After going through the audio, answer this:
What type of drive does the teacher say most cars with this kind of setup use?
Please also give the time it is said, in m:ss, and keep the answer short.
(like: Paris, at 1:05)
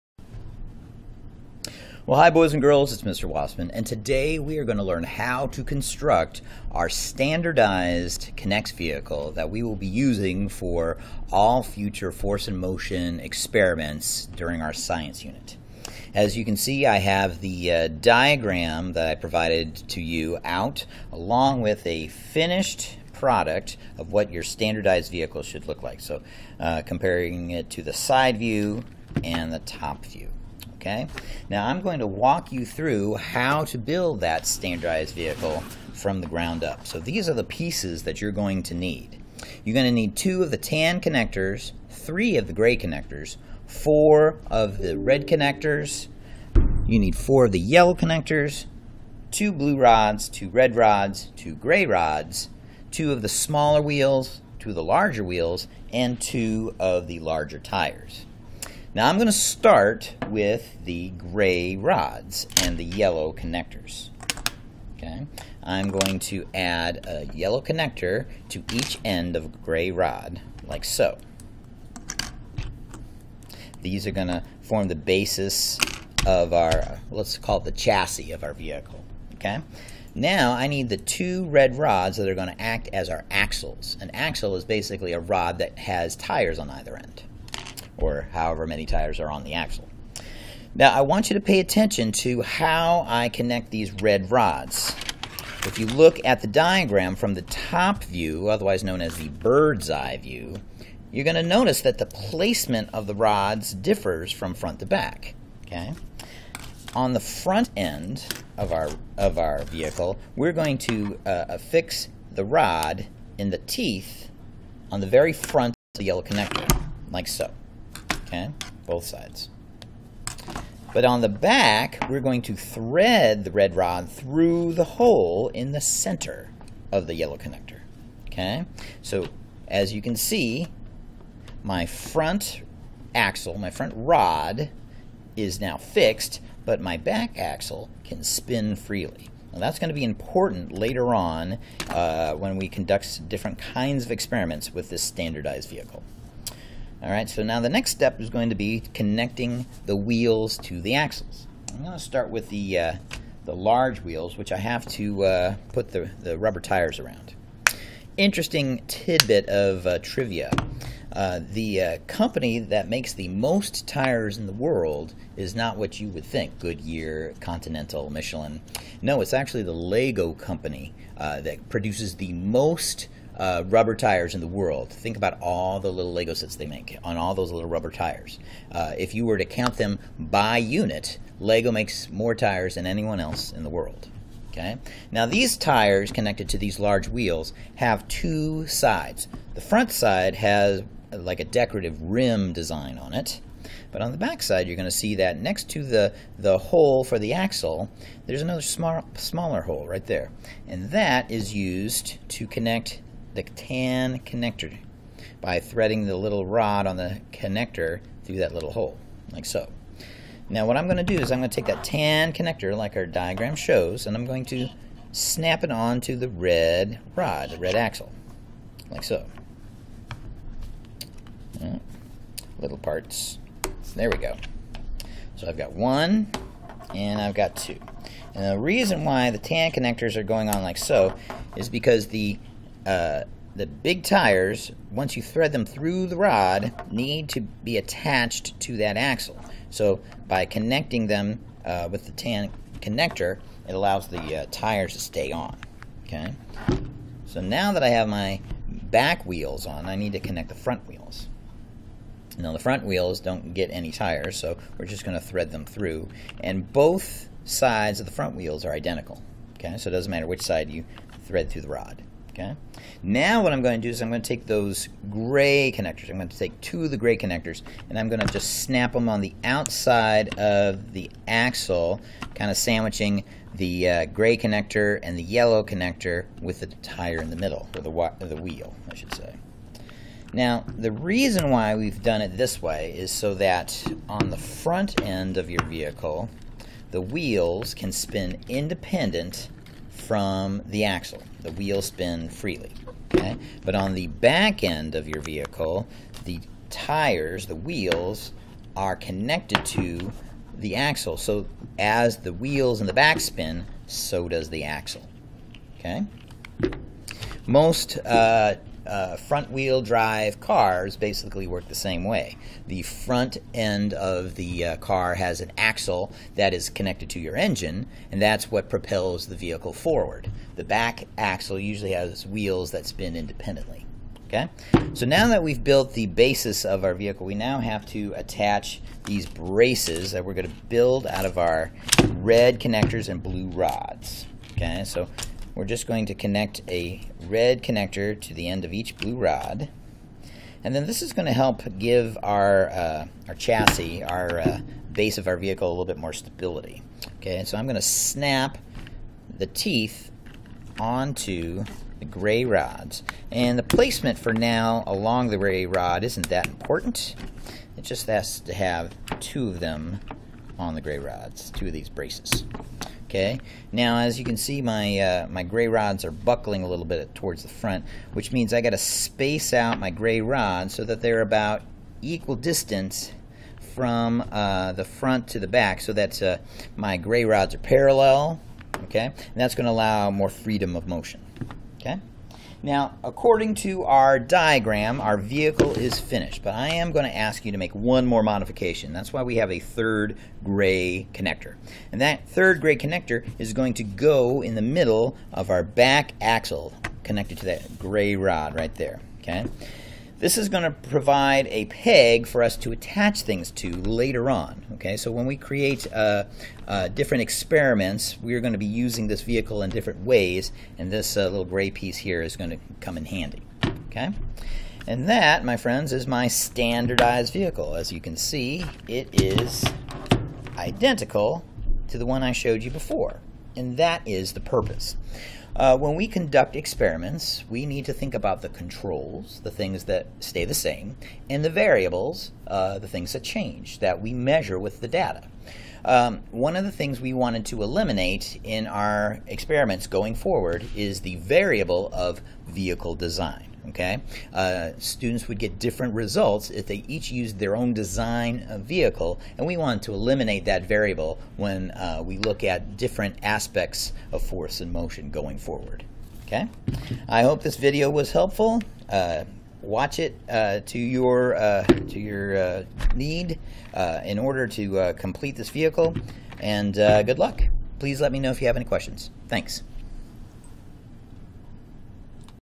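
front wheel drive, at 5:09.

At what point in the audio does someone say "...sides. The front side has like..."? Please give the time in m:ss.
3:08.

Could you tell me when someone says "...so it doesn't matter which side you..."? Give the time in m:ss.
4:19.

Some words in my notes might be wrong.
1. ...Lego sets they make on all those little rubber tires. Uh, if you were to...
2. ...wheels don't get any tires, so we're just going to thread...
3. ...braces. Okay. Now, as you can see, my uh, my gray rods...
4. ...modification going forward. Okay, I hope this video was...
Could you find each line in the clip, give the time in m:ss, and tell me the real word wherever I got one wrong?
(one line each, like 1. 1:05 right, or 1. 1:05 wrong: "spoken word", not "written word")
1. 2:56 right
2. 4:12 right
3. 6:01 right
4. 7:34 wrong: "motion", not "modification".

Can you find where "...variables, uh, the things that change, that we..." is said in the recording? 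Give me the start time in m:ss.
7:11.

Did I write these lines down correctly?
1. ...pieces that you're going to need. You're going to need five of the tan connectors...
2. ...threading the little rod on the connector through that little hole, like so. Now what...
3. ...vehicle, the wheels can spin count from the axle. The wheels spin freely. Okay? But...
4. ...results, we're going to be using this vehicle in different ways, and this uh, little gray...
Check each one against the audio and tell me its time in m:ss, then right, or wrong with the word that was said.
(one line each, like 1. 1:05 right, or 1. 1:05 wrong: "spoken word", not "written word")
1. 0:37 wrong: "two", not "five"
2. 3:25 right
3. 4:45 wrong: "independent", not "count"
4. 6:47 wrong: "experiments", not "results".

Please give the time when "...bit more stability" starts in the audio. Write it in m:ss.
5:45.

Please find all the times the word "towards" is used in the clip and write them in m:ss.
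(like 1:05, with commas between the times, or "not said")
6:07.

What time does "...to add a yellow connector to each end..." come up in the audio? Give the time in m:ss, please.
1:06.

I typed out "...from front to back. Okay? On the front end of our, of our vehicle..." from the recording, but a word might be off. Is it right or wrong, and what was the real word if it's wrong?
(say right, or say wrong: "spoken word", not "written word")
right.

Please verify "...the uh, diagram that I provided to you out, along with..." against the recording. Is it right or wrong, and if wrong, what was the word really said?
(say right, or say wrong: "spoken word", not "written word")
right.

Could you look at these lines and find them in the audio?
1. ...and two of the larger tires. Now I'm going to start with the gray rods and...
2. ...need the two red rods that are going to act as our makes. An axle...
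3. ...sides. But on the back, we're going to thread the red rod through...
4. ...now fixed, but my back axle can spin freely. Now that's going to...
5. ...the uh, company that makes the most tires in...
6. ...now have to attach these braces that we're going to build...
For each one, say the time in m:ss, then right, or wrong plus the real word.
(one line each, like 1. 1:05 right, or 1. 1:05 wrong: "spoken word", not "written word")
1. 0:55 right
2. 1:20 wrong: "axles", not "makes"
3. 1:59 right
4. 2:15 right
5. 2:41 right
6. 5:27 right.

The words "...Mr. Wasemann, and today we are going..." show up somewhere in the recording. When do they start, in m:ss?
0:03.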